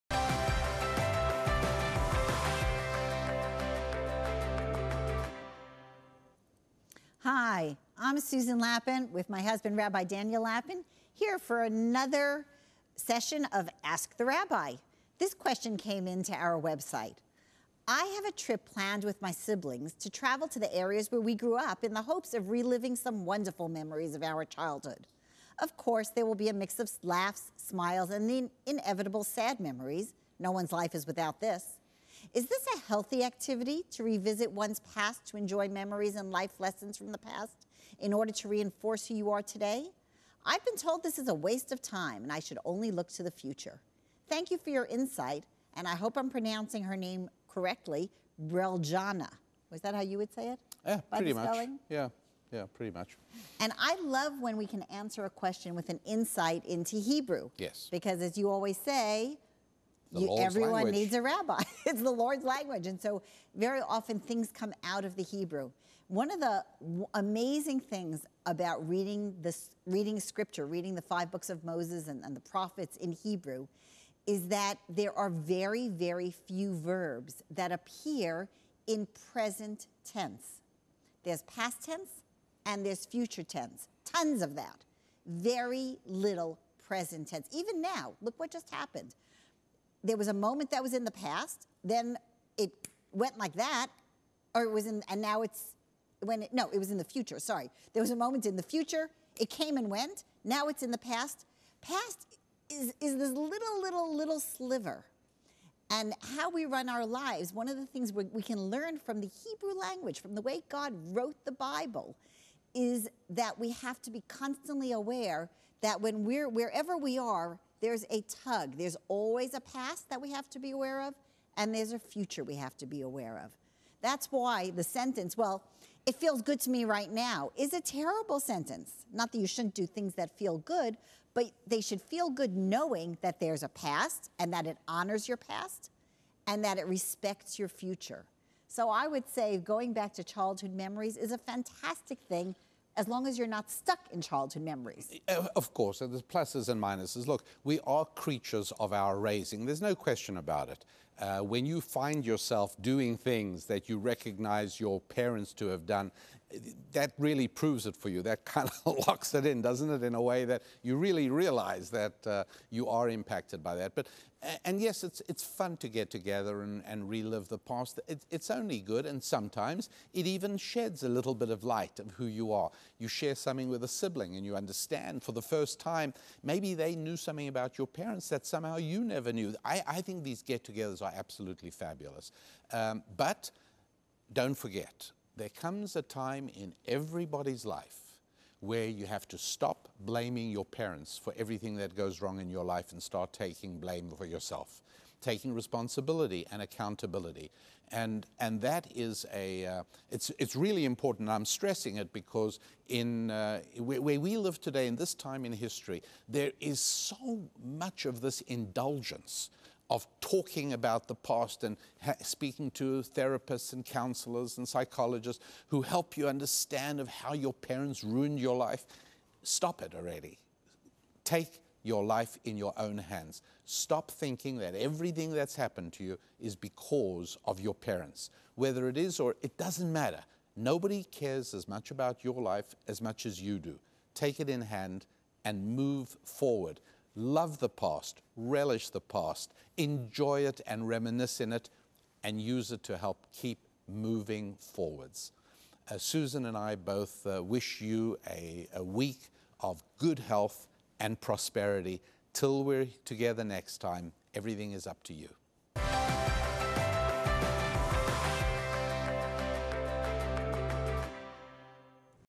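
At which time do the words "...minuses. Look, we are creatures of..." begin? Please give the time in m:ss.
2:26.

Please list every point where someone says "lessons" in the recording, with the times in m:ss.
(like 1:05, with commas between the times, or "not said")
0:36.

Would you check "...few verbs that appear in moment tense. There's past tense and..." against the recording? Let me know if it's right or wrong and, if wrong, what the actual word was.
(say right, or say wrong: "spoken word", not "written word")
wrong: "present", not "moment".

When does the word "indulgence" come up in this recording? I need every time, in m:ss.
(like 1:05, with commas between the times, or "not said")
3:28.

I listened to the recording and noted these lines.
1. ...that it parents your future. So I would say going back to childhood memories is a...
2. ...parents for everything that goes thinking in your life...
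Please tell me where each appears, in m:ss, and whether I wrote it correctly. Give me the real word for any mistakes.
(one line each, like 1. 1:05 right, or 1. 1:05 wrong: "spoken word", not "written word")
1. 2:16 wrong: "respects", not "parents"
2. 3:10 wrong: "wrong", not "thinking".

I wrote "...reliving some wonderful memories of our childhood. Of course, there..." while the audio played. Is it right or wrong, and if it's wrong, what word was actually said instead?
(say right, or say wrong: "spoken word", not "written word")
right.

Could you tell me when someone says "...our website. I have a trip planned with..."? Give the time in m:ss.
0:16.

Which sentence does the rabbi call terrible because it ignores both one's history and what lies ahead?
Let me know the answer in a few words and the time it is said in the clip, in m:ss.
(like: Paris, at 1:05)
It feels good to me right now, at 2:06.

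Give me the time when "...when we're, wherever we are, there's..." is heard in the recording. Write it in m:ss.
1:56.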